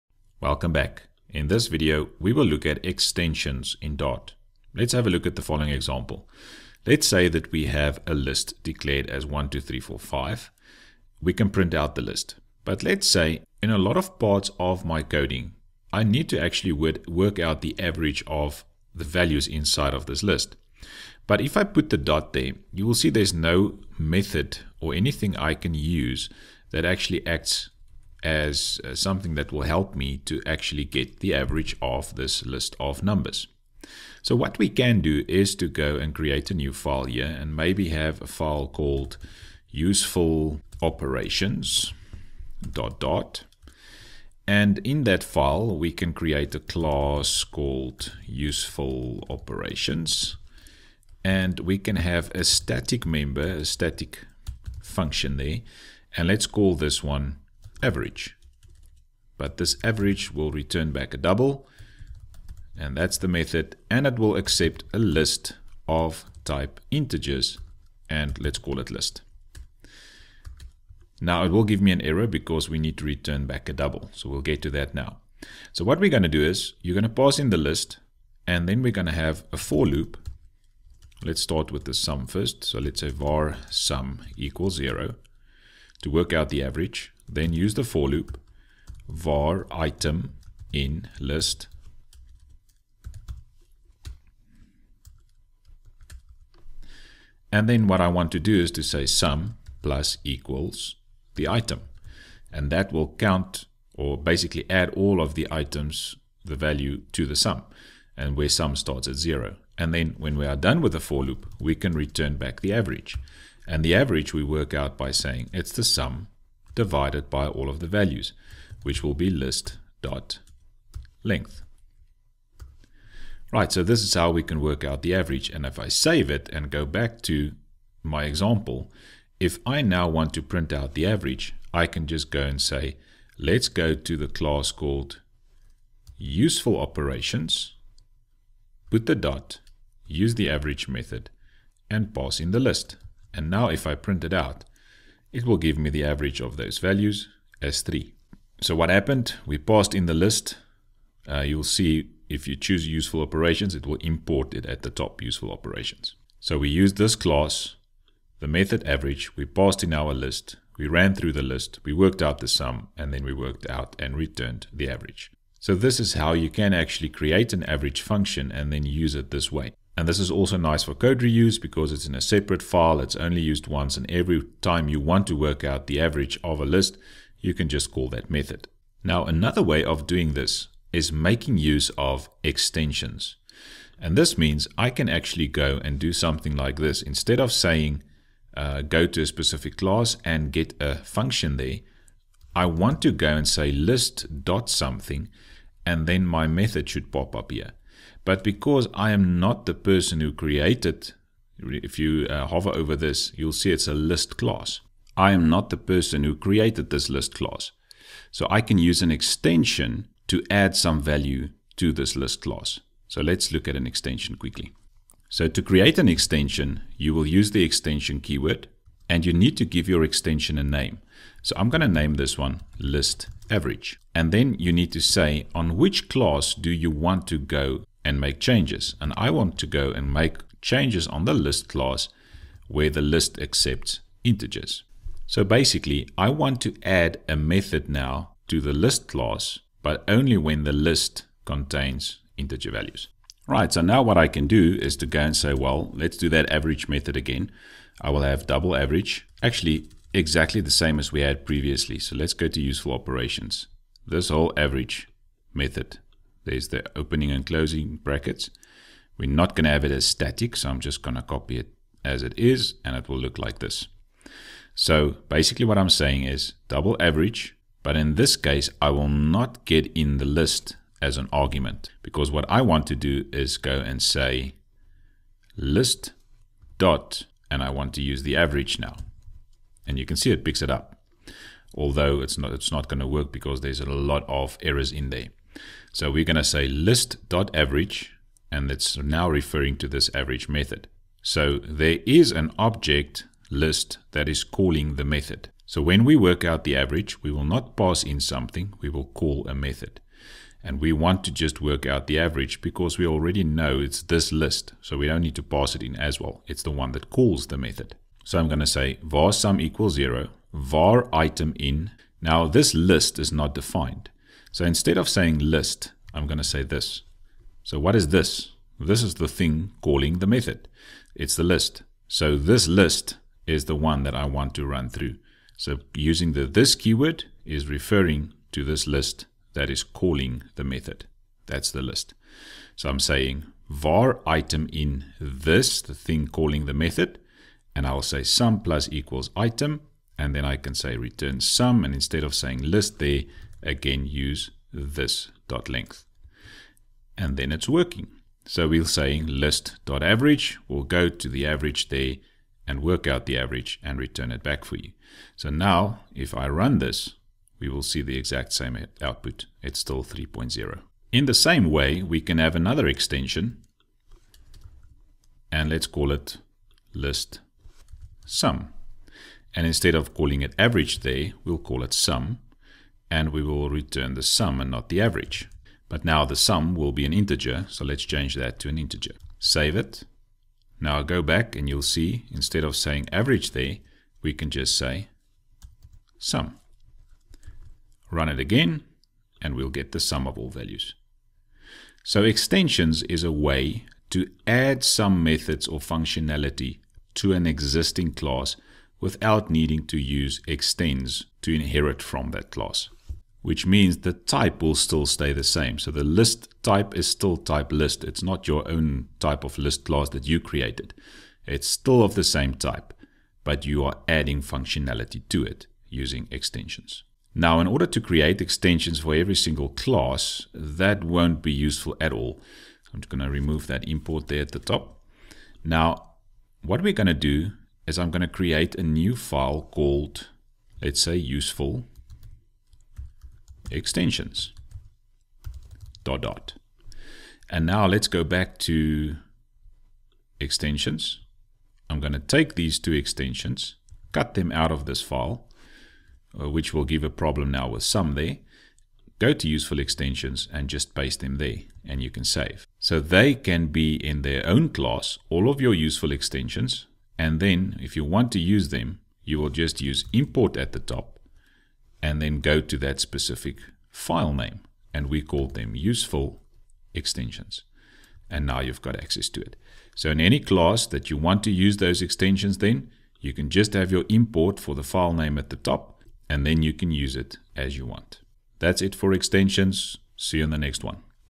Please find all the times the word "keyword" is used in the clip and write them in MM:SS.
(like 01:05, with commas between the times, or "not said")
03:38, 05:26.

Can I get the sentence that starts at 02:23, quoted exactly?
And now if I print it out, it will give me the average of those values as 3.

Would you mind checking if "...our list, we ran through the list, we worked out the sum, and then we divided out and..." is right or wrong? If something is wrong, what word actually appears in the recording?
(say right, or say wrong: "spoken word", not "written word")
wrong: "worked", not "divided".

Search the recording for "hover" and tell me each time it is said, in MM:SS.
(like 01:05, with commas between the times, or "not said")
03:22.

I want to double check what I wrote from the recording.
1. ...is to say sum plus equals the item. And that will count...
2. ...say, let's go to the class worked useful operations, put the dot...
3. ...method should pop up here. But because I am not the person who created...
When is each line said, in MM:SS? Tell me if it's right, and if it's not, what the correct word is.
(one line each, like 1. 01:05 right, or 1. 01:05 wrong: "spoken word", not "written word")
1. 01:38 right
2. 02:12 wrong: "called", not "worked"
3. 03:16 right.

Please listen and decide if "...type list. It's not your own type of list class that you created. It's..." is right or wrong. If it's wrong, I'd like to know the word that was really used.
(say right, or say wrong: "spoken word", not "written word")
right.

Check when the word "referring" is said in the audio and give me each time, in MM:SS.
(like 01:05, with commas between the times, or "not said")
04:49, 05:27.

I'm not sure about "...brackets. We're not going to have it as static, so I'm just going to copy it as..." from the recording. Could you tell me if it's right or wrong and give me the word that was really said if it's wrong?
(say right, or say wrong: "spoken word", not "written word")
right.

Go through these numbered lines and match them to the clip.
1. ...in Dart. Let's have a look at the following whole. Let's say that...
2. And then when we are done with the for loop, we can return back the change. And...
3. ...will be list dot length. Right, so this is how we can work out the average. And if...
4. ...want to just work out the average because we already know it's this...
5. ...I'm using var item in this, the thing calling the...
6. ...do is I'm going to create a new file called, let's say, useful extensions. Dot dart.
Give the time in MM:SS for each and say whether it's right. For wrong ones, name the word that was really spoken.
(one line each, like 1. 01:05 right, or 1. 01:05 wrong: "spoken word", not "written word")
1. 00:03 wrong: "example", not "whole"
2. 01:49 wrong: "average", not "change"
3. 01:59 right
4. 05:00 right
5. 05:32 wrong: "saying", not "using"
6. 07:07 right.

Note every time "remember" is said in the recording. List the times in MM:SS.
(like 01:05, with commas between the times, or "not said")
not said.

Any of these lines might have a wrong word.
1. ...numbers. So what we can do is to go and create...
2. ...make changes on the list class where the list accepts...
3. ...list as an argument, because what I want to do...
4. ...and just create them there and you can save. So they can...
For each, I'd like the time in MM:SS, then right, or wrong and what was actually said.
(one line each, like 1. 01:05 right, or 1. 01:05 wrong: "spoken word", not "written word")
1. 00:33 right
2. 03:50 right
3. 04:30 right
4. 07:30 wrong: "paste", not "create".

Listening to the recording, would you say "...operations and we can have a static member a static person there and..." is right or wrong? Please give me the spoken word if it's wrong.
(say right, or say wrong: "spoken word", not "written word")
wrong: "function", not "person".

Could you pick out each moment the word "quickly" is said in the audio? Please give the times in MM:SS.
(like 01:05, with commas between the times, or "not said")
03:34.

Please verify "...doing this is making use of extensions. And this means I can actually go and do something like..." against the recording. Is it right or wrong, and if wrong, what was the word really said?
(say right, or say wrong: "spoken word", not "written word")
right.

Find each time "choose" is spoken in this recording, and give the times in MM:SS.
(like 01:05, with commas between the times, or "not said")
02:32.